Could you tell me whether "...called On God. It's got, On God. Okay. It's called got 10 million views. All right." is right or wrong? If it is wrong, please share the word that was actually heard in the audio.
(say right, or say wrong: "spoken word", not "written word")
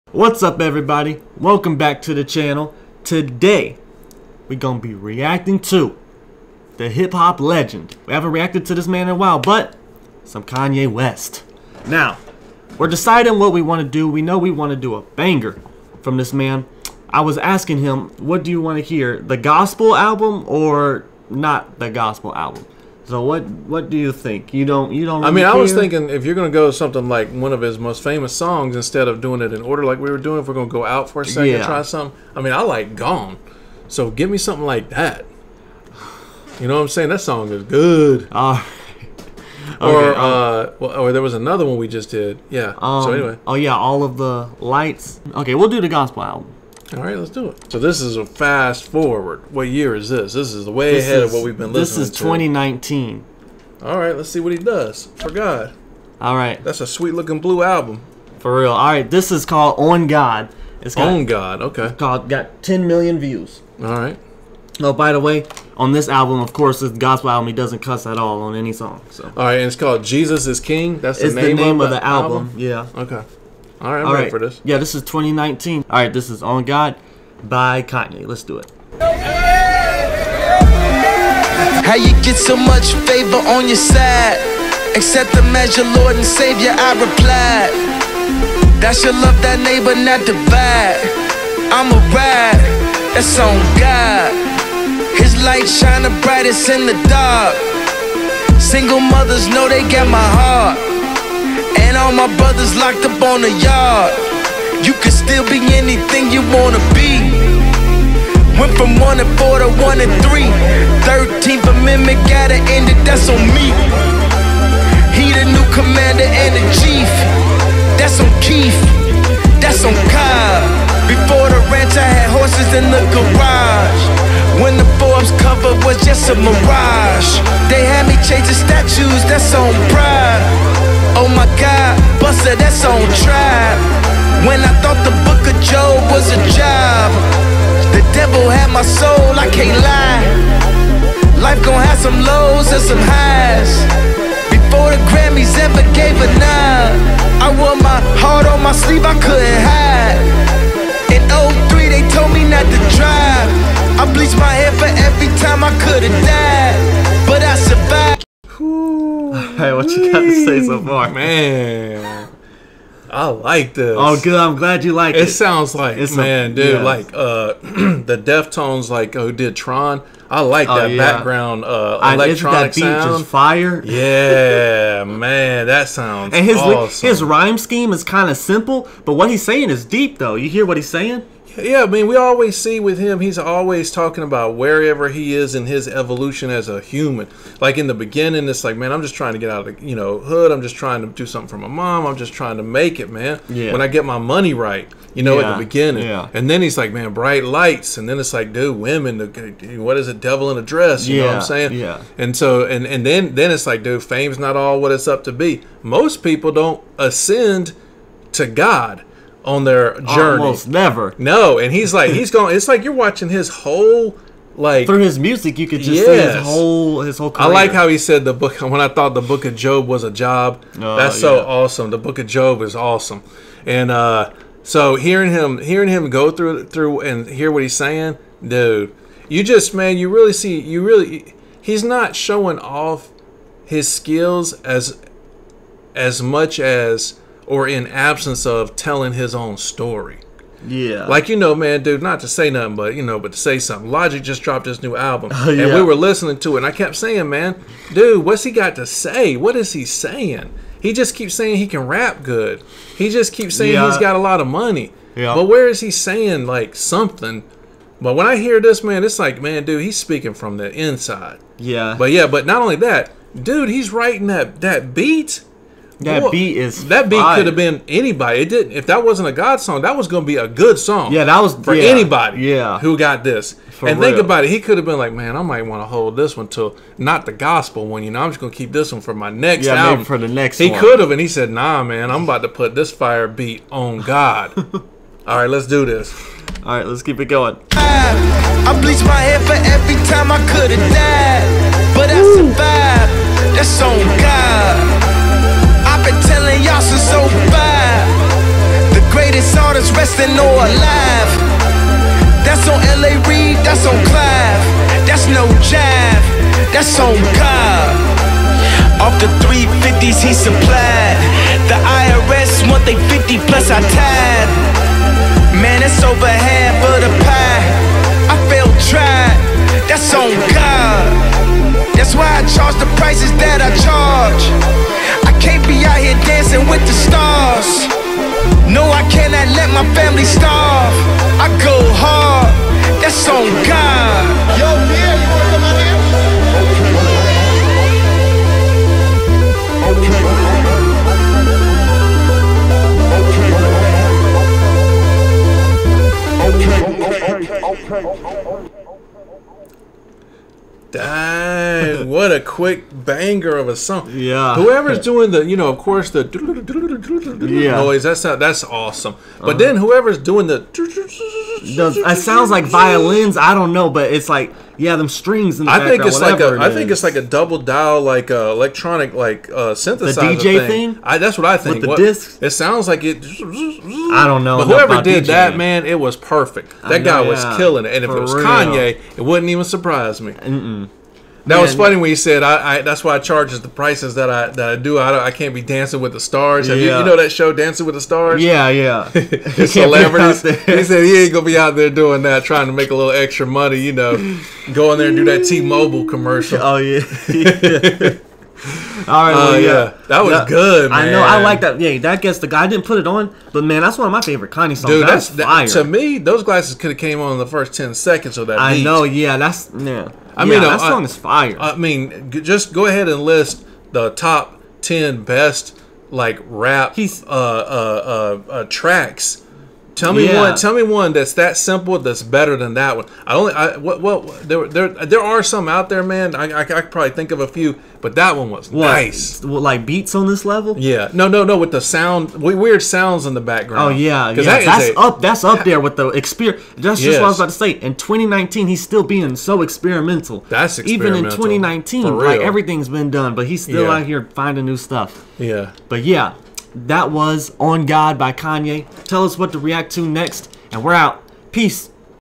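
right.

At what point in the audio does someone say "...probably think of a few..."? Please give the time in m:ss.
7:06.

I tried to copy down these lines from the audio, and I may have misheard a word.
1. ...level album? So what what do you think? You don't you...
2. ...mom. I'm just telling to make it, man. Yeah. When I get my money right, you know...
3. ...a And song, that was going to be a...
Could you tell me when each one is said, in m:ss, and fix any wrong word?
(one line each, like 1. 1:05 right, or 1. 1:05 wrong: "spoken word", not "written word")
1. 0:21 wrong: "gospel", not "level"
2. 3:11 wrong: "trying", not "telling"
3. 4:29 wrong: "God", not "And".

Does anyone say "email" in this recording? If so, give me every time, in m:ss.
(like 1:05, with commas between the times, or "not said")
not said.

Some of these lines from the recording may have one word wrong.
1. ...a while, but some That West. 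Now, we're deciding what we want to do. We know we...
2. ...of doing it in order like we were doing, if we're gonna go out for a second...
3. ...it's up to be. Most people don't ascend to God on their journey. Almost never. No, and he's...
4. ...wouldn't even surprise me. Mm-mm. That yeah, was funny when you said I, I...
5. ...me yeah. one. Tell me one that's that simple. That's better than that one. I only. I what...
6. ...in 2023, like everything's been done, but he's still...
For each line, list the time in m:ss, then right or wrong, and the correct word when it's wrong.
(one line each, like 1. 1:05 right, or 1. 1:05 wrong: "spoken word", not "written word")
1. 0:09 wrong: "Kanye", not "That"
2. 0:29 right
3. 3:24 right
4. 6:19 right
5. 7:00 right
6. 7:21 wrong: "2019", not "2023".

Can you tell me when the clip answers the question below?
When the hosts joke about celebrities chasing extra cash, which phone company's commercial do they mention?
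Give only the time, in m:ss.
6:35.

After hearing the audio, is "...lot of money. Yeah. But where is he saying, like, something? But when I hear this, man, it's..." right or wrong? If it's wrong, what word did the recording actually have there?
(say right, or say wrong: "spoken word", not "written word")
right.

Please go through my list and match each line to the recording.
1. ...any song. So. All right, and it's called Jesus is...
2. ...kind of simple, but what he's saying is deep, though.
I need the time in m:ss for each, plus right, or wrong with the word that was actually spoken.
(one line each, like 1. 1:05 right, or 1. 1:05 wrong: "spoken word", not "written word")
1. 1:08 right
2. 2:58 right.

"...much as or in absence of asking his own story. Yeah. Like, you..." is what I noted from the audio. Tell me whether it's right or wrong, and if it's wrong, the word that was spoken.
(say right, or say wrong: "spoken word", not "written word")
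wrong: "telling", not "asking".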